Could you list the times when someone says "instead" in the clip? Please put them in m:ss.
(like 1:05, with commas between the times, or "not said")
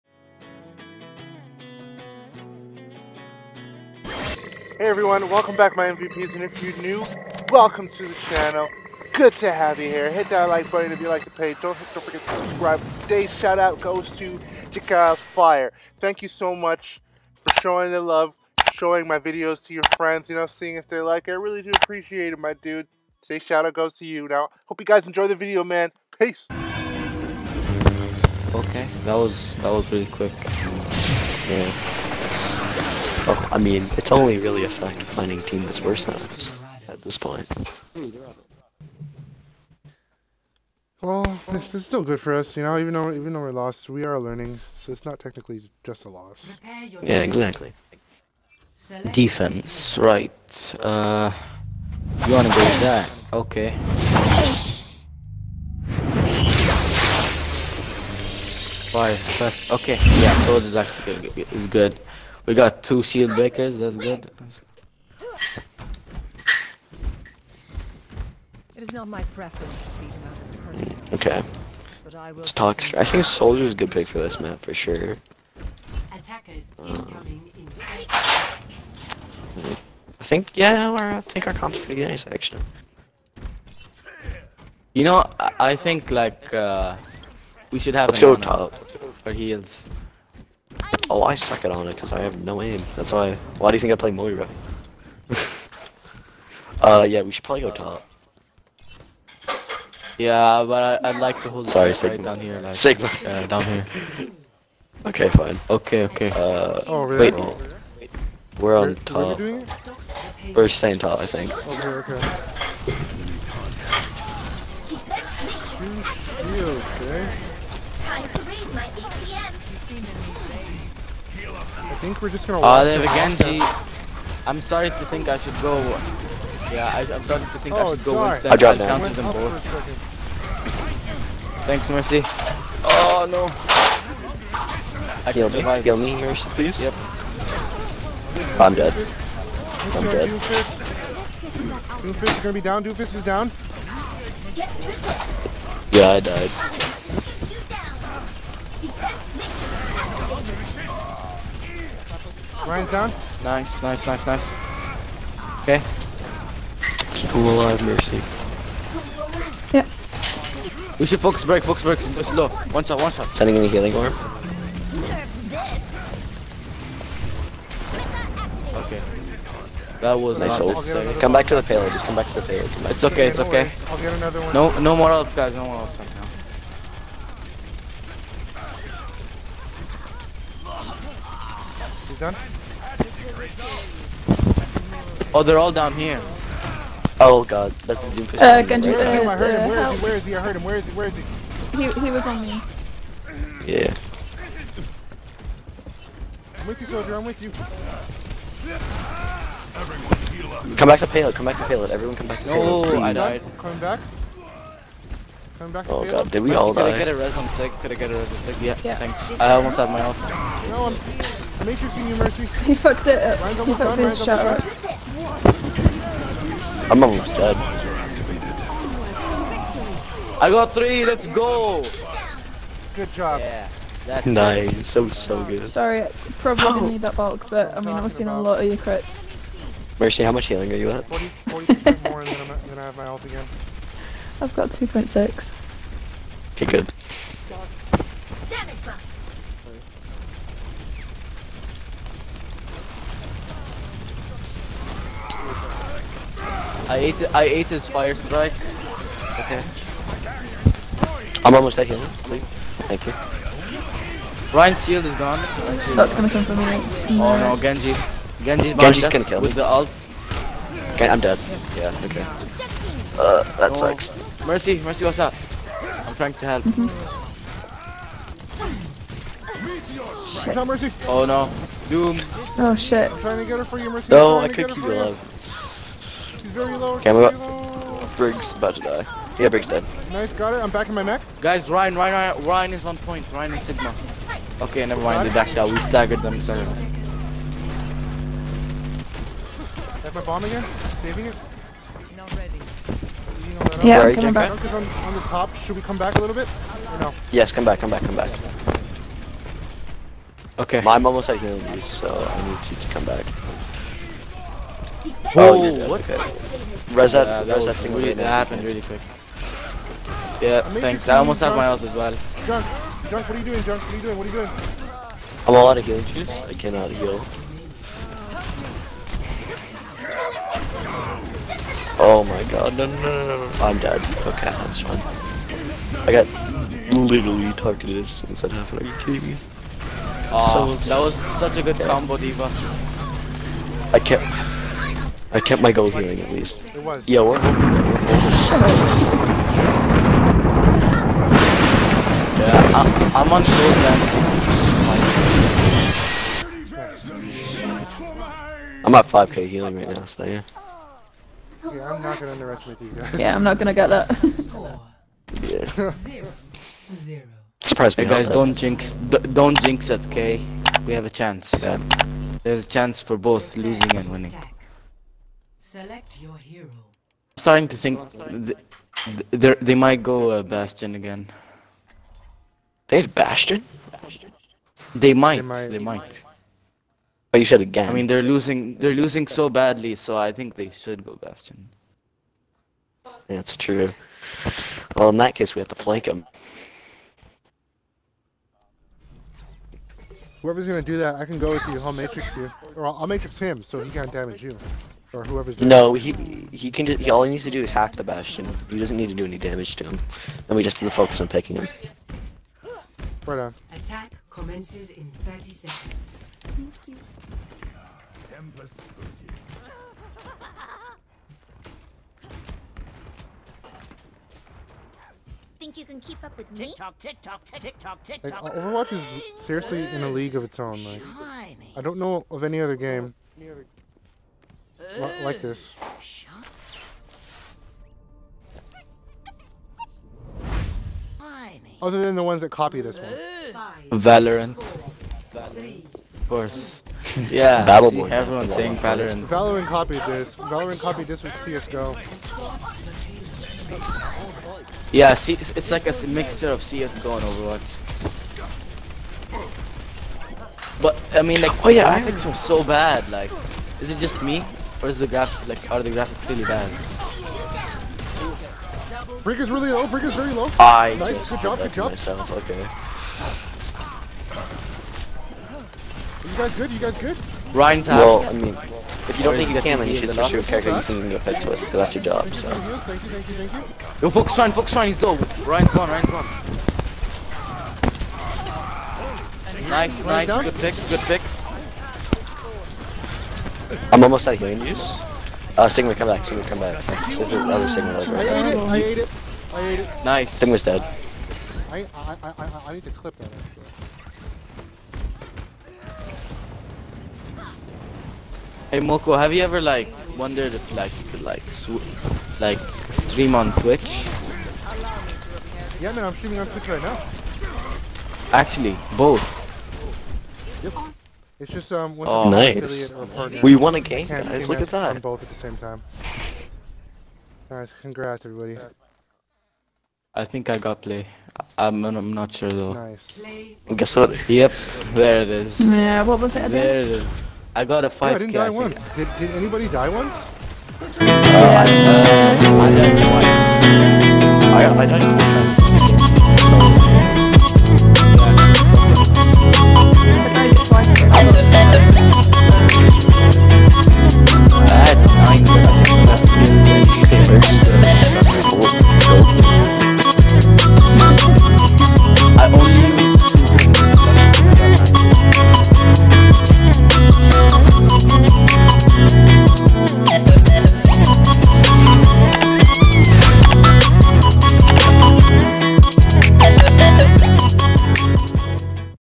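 2:08, 5:27.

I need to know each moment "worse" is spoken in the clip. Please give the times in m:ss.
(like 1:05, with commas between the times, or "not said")
0:35.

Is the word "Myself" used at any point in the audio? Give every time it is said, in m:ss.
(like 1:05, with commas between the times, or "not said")
7:41.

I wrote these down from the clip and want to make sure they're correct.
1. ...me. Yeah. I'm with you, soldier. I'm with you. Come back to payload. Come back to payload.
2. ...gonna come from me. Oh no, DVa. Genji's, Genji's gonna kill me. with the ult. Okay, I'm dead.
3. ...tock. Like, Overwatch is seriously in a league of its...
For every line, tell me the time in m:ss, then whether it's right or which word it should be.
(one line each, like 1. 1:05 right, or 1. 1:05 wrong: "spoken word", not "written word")
1. 3:12 right
2. 4:16 wrong: "Genji", not "DVa"
3. 6:58 right.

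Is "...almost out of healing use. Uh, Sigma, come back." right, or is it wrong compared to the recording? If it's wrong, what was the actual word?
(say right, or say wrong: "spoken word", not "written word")
right.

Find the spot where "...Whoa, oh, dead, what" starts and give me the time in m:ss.
5:05.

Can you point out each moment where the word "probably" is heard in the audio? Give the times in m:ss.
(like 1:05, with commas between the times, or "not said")
1:37, 3:46.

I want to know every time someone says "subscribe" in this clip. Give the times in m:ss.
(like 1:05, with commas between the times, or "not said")
0:12.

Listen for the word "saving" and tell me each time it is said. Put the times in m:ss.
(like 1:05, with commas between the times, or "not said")
4:50.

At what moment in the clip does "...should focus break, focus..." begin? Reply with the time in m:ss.
2:41.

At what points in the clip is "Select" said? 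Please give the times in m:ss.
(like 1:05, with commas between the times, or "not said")
6:05.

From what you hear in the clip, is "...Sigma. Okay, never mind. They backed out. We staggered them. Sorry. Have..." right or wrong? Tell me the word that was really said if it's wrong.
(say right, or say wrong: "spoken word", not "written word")
right.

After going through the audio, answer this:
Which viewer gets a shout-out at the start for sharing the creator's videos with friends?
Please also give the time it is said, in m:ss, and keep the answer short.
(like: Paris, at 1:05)
Chikaos Fire, at 0:14.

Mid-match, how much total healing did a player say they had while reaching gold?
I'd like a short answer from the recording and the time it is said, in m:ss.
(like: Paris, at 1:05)
5k, at 5:49.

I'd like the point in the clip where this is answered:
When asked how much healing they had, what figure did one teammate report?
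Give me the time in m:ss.
3:54.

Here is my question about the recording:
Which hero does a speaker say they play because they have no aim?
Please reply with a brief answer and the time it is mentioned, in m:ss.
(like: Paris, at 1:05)
Moira, at 1:34.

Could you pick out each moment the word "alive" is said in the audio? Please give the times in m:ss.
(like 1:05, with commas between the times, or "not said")
2:37, 4:34.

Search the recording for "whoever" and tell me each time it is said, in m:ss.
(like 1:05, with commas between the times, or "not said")
6:30, 6:35.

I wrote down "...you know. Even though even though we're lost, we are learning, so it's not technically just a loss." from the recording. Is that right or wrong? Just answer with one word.
right.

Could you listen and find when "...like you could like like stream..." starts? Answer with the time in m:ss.
8:20.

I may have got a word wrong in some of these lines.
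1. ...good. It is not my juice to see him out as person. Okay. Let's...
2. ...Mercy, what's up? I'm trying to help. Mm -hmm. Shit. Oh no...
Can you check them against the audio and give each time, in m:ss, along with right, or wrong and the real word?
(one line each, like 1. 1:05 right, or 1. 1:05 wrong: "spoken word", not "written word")
1. 1:03 wrong: "preference", not "juice"
2. 4:24 right.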